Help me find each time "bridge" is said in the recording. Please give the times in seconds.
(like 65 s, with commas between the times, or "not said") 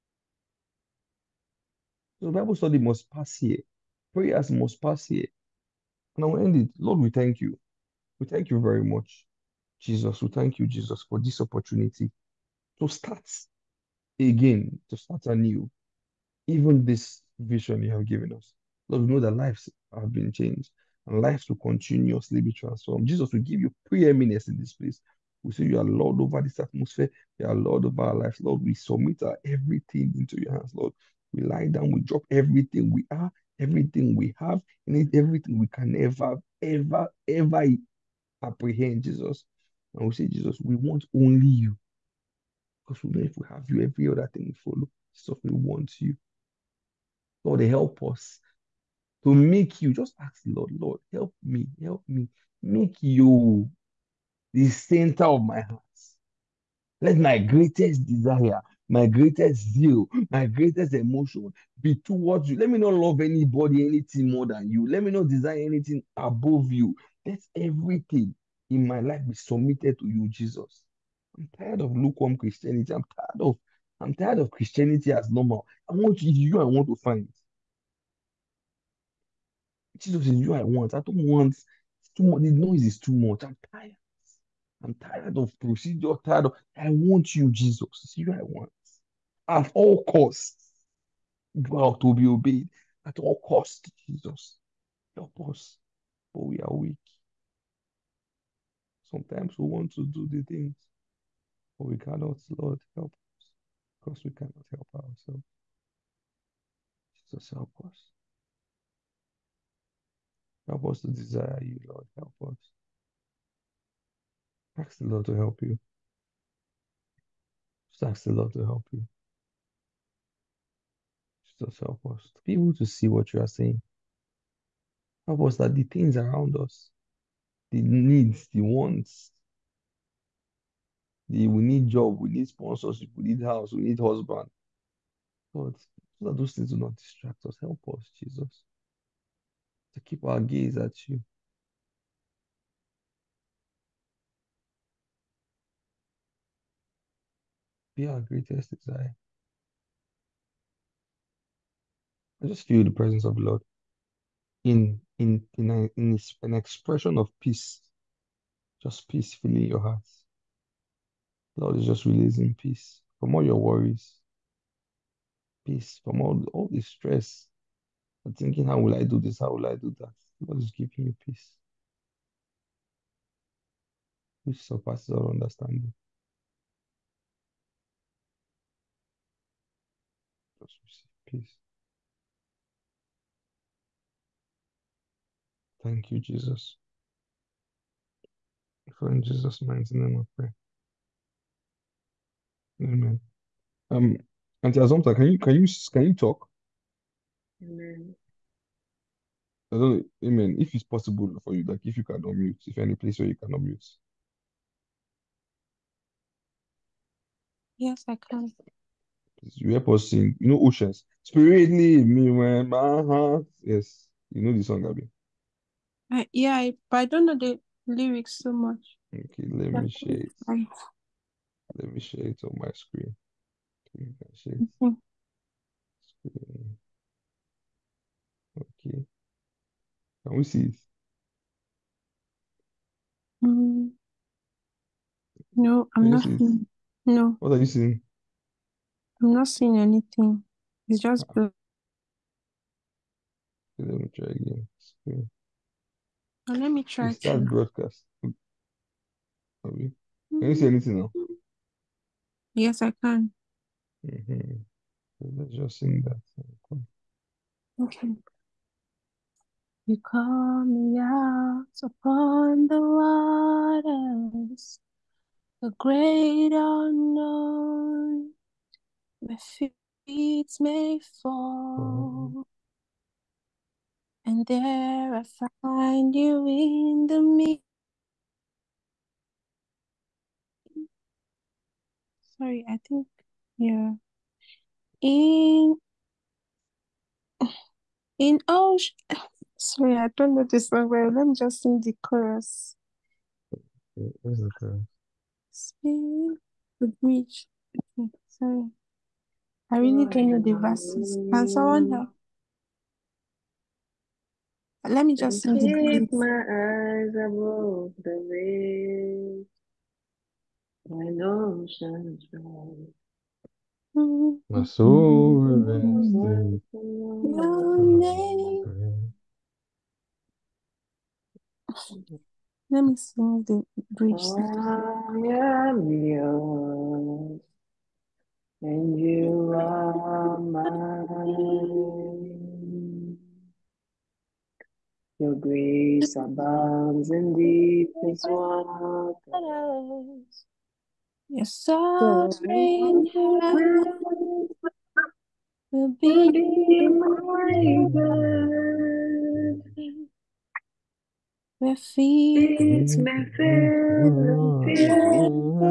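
297 s, 323 s.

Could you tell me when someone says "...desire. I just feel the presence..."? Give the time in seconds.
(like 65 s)
148 s.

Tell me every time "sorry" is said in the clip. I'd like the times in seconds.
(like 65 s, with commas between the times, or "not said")
282 s, 289 s, 298 s.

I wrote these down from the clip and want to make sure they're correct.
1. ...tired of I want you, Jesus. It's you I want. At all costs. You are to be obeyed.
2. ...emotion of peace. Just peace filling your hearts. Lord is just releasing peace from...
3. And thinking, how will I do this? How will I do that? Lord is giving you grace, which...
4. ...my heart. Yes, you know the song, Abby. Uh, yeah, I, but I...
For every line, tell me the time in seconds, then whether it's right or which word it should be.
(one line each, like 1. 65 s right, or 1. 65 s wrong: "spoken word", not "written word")
1. 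86 s right
2. 156 s wrong: "expression", not "emotion"
3. 168 s wrong: "peace", not "grace"
4. 212 s right.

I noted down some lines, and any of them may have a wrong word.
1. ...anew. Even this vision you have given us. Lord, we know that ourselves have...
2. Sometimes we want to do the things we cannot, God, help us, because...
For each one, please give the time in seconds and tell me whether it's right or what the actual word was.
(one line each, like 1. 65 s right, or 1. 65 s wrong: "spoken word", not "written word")
1. 15 s wrong: "lives", not "ourselves"
2. 99 s wrong: "Lord", not "God".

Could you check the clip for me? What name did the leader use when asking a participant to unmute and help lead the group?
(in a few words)
Auntie Azumta.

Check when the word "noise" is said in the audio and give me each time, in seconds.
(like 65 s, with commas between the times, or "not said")
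82 s.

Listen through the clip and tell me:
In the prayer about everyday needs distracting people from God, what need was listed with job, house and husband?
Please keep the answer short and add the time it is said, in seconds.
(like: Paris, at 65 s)
sponsorship, at 132 s.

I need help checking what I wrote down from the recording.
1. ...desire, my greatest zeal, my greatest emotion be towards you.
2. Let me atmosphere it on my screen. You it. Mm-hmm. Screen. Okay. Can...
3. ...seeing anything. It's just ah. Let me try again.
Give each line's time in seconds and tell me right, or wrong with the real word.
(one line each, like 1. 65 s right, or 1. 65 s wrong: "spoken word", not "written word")
1. 58 s right
2. 221 s wrong: "share", not "atmosphere"
3. 239 s right.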